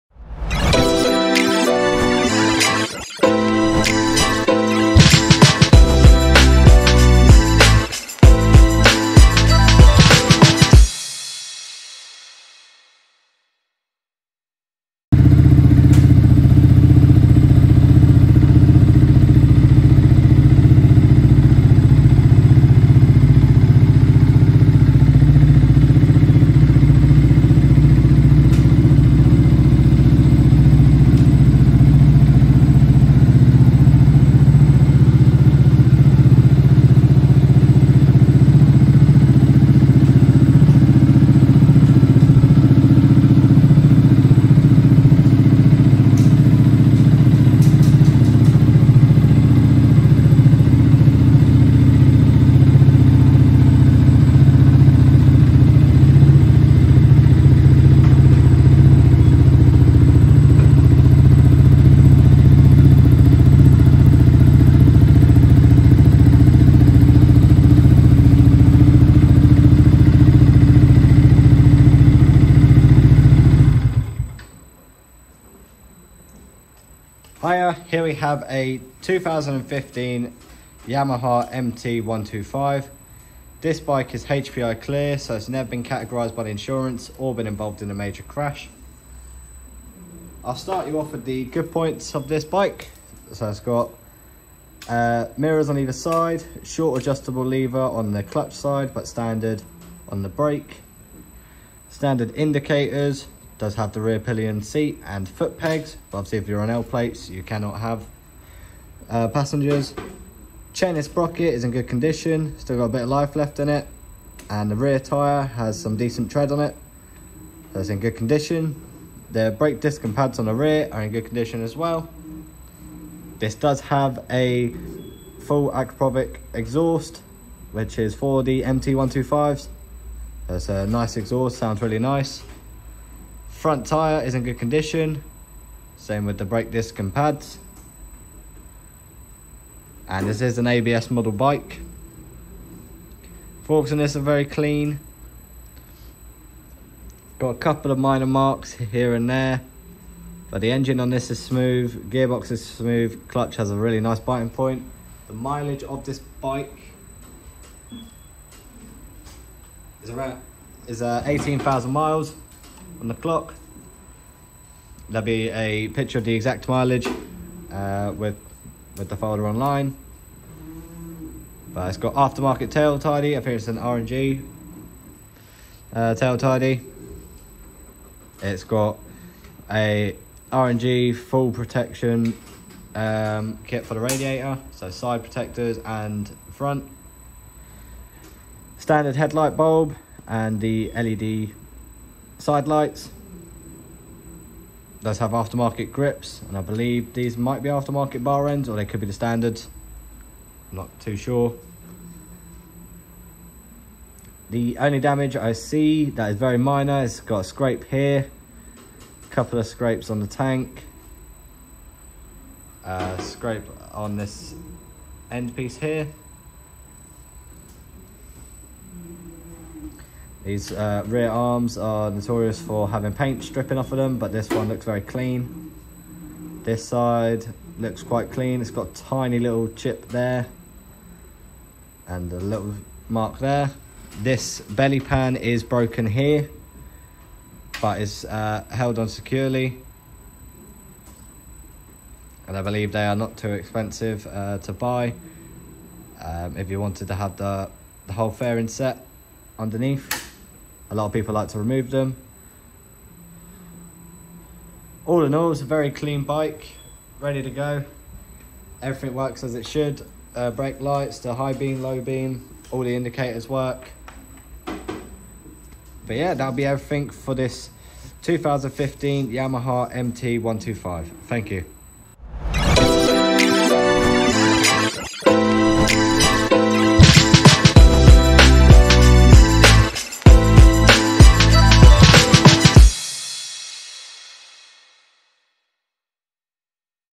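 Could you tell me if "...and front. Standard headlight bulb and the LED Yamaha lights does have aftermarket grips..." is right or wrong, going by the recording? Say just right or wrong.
wrong.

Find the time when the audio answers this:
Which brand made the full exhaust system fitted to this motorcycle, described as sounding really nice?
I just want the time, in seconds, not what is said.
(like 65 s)
125 s.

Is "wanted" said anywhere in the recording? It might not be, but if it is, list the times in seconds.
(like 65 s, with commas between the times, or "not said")
246 s.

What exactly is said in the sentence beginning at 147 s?
Got a couple of minor marks here and there.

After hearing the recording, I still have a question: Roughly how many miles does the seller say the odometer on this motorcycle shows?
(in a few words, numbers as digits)
18,000 miles.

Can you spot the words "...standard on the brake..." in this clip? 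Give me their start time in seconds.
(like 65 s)
99 s.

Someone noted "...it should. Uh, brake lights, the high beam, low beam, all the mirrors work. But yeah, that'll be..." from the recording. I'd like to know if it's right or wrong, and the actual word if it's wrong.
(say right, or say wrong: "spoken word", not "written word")
wrong: "indicators", not "mirrors".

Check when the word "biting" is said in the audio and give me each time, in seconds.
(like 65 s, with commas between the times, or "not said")
154 s.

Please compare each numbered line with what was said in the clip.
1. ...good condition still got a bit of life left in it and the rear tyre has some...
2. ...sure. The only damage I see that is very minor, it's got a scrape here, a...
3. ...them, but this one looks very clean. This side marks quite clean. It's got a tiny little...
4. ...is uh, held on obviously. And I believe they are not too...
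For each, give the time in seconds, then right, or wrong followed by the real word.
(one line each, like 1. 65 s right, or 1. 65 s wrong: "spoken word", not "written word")
1. 111 s right
2. 201 s right
3. 223 s wrong: "looks", not "marks"
4. 238 s wrong: "securely", not "obviously".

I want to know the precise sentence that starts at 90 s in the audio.
I'll start you off with the good points of this bike.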